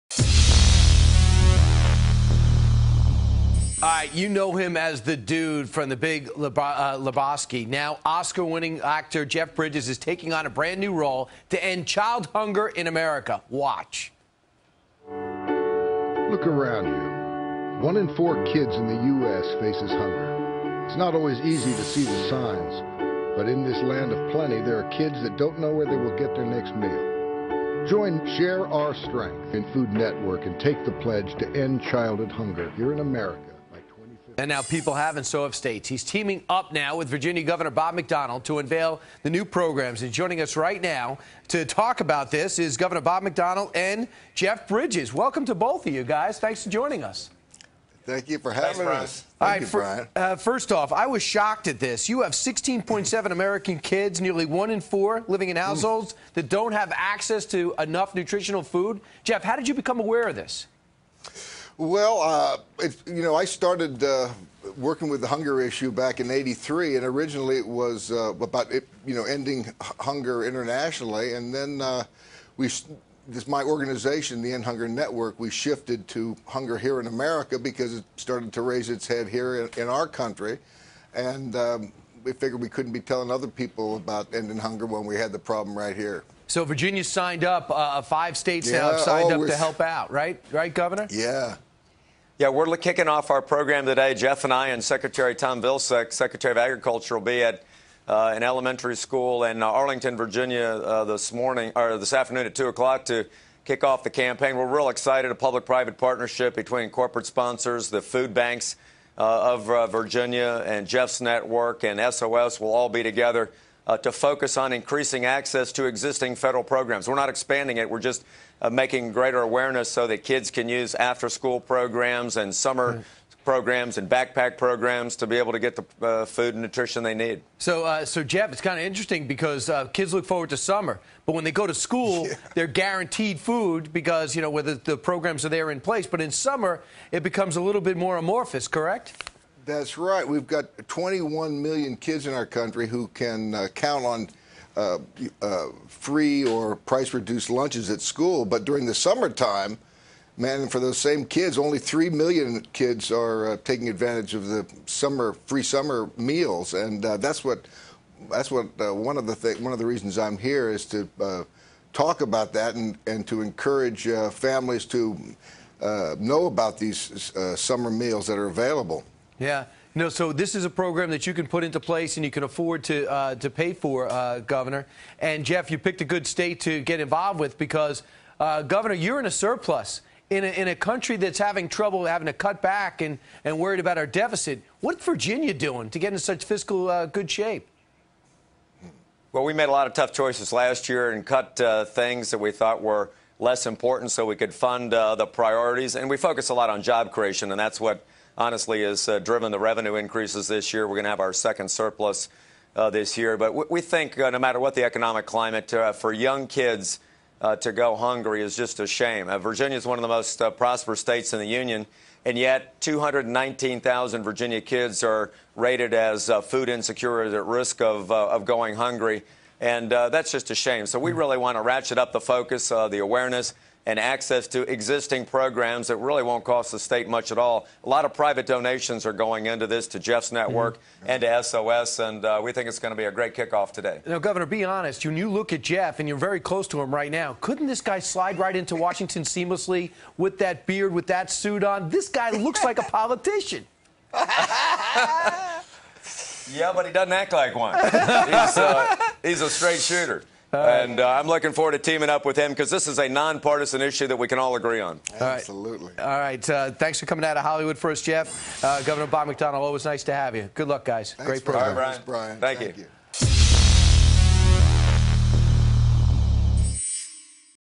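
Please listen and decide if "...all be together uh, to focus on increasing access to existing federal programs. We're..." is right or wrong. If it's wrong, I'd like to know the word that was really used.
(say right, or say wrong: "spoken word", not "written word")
right.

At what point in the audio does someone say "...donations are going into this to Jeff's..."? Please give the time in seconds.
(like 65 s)
228 s.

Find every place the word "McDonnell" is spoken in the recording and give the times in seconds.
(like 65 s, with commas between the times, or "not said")
37 s, 43 s, 259 s.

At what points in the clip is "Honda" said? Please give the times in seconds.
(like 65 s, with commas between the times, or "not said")
not said.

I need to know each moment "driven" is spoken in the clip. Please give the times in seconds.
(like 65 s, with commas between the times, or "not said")
199 s.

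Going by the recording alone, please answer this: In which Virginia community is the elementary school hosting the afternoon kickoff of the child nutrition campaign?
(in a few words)
Arlington.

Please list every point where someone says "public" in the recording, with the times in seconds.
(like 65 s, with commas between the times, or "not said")
105 s.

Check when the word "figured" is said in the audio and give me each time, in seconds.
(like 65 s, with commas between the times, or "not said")
82 s.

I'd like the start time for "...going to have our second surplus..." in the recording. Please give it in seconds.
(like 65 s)
200 s.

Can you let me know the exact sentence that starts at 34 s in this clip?
And now people have, and so have states.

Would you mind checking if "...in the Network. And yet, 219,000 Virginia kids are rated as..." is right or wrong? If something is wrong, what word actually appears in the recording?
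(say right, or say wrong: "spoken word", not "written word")
wrong: "Union", not "Network".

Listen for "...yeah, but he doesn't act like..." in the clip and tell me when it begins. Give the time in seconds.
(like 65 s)
244 s.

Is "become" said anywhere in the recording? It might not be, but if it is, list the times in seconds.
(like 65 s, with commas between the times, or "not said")
59 s, 137 s.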